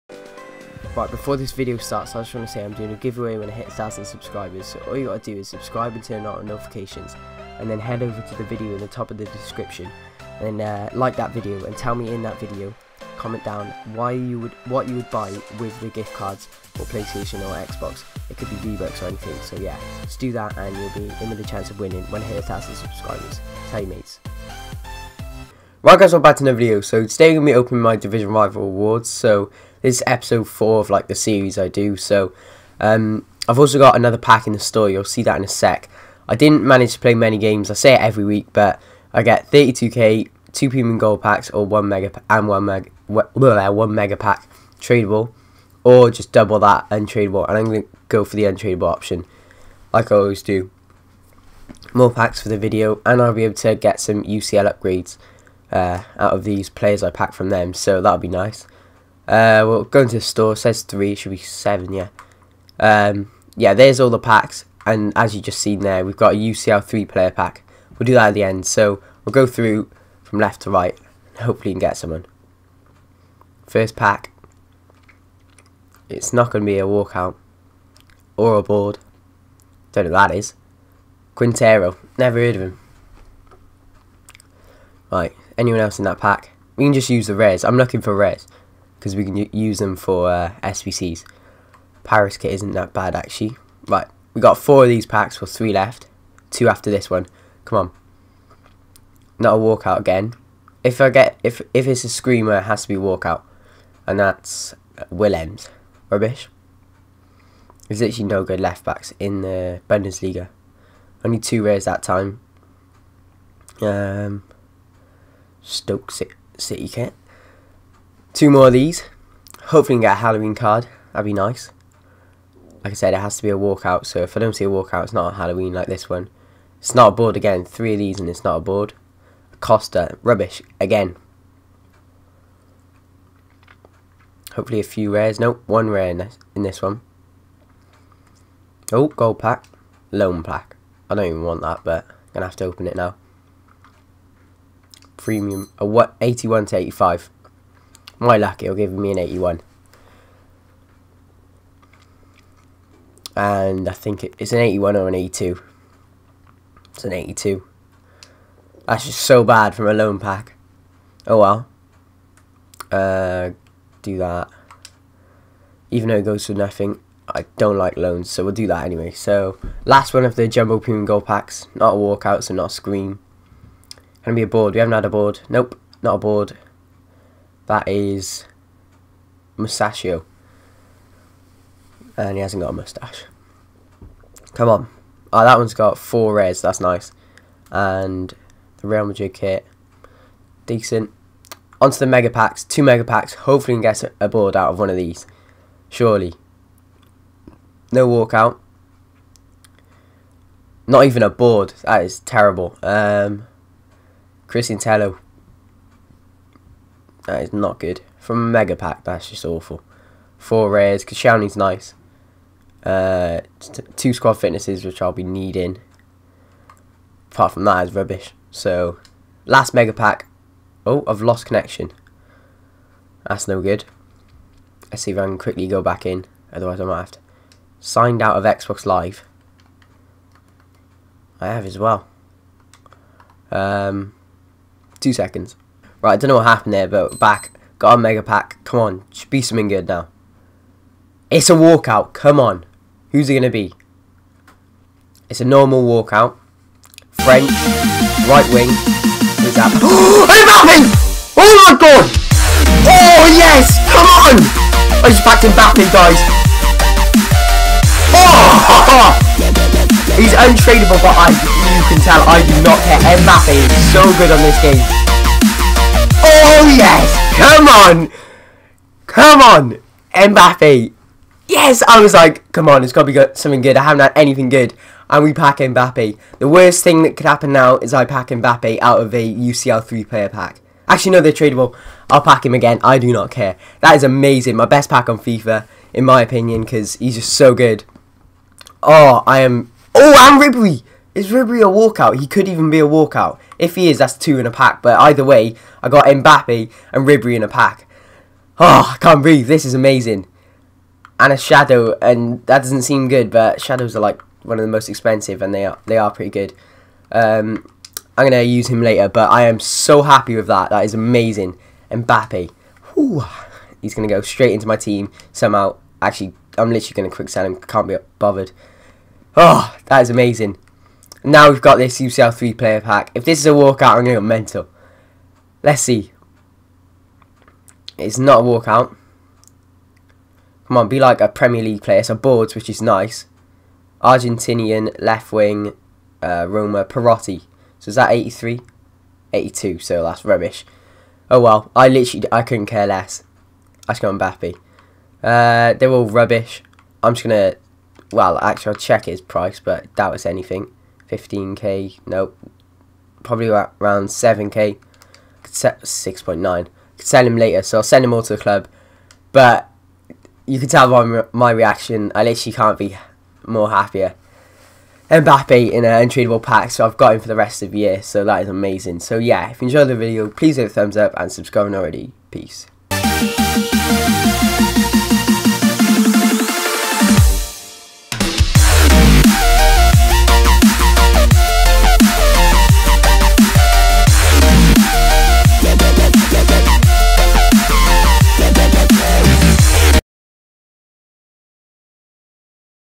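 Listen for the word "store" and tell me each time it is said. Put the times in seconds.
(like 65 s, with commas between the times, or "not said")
34 s, 60 s.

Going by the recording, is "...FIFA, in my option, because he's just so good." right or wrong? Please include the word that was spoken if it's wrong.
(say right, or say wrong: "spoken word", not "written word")
wrong: "opinion", not "option".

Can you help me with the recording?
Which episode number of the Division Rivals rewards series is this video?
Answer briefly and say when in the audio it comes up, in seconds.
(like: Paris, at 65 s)
4, at 30 s.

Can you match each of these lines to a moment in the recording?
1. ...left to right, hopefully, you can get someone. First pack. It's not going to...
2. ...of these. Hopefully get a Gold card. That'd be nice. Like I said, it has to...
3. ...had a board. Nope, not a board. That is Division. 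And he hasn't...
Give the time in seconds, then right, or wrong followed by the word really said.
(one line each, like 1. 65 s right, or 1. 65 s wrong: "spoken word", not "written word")
1. 70 s right
2. 118 s wrong: "Halloween", not "Gold"
3. 174 s wrong: "Mustachio", not "Division".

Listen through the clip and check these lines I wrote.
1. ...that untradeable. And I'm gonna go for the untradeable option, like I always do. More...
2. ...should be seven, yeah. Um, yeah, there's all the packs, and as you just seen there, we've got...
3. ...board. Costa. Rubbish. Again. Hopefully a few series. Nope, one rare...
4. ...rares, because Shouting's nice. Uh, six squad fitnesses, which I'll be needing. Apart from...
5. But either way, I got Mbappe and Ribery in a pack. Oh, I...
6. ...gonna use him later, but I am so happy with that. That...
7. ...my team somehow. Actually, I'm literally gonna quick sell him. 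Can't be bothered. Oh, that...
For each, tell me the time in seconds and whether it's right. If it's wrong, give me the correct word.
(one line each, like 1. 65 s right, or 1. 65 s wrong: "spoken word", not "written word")
1. 46 s right
2. 61 s right
3. 128 s wrong: "rares", not "series"
4. 210 s wrong: "two", not "six"
5. 294 s right
6. 308 s right
7. 314 s right.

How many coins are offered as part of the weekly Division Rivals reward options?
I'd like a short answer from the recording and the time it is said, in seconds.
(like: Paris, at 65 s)
32k, at 39 s.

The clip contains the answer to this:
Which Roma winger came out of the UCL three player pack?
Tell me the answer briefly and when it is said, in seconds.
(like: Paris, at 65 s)
Perotti, at 336 s.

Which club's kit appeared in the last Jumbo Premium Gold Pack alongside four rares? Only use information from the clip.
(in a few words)
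Real Madrid.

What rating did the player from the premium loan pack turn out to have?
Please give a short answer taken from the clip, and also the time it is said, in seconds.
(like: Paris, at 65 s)
82, at 156 s.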